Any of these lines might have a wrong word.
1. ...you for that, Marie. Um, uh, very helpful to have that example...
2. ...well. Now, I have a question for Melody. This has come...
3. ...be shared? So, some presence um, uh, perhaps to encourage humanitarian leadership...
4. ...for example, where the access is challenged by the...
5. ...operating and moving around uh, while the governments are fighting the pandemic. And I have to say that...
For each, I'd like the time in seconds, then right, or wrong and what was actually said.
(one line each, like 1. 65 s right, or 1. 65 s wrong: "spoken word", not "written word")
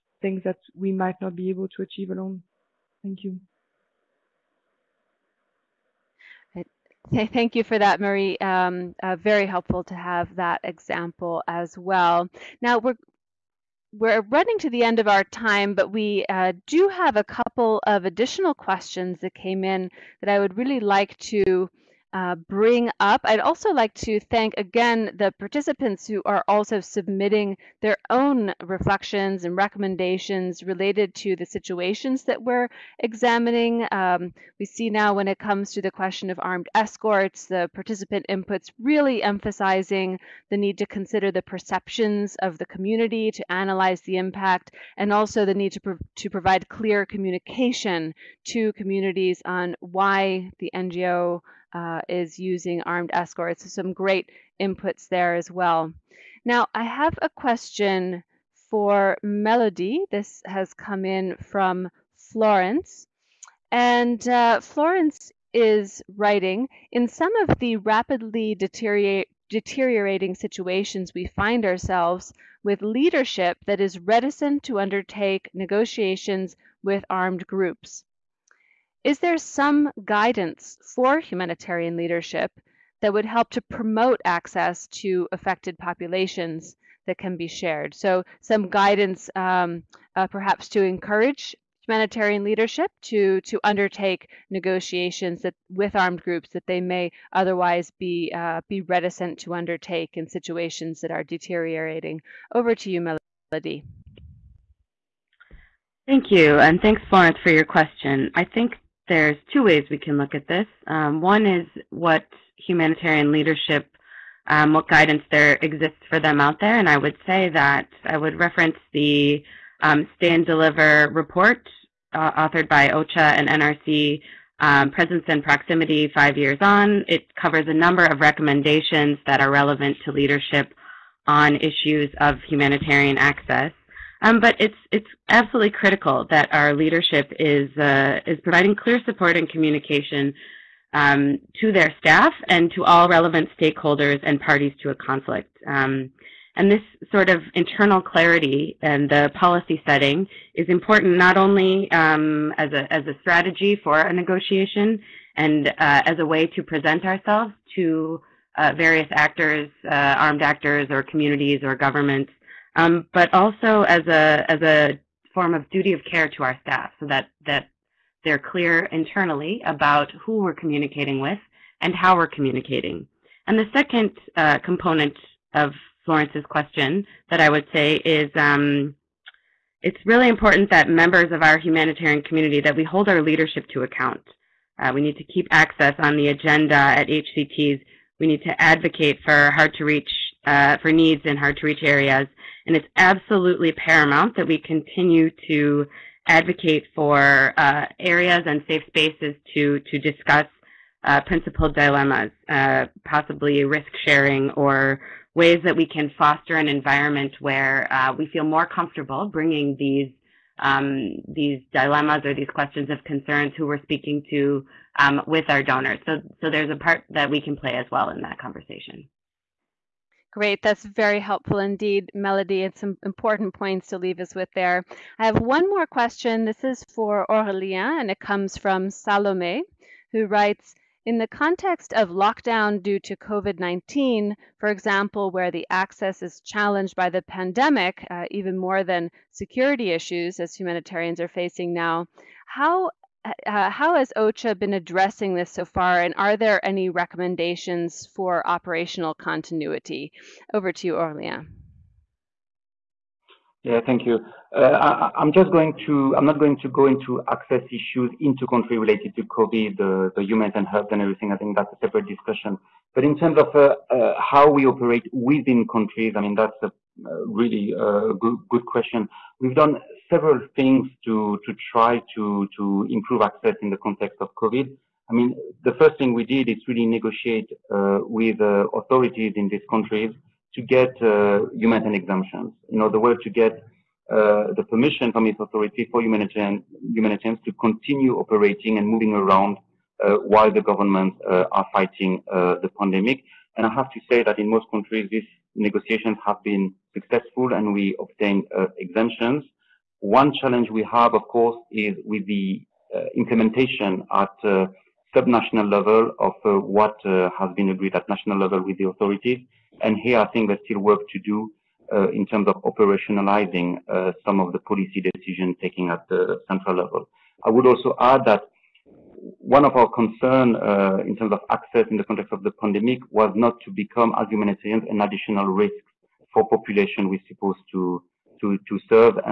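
1. 7 s right
2. 55 s right
3. 87 s wrong: "guidance", not "presence"
4. 234 s right
5. 288 s right.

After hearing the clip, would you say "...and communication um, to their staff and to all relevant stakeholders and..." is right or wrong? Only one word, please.
right.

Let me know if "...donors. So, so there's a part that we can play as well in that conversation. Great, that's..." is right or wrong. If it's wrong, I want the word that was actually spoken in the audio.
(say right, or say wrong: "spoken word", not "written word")
right.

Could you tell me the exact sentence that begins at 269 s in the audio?
We've done several things to, to try to, to improve access in the context of COVID.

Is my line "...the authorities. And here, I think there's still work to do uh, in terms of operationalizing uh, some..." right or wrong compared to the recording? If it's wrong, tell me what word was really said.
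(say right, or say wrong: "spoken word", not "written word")
right.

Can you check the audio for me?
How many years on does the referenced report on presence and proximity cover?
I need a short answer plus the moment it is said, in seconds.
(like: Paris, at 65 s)
5, at 126 s.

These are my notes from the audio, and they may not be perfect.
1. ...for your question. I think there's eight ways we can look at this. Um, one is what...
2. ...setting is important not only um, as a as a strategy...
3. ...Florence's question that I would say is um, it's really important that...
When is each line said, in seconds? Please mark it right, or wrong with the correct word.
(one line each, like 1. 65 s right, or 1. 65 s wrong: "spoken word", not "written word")
1. 107 s wrong: "two", not "eight"
2. 149 s right
3. 176 s right.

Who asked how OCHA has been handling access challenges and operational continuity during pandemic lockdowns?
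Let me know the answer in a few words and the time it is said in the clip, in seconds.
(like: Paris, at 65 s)
Salome, at 228 s.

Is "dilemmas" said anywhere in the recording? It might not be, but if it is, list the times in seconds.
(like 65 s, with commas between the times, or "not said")
201 s, 211 s.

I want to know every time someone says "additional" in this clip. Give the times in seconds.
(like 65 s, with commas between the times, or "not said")
18 s, 325 s.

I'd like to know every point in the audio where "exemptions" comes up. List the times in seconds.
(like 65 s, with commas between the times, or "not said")
282 s, 298 s.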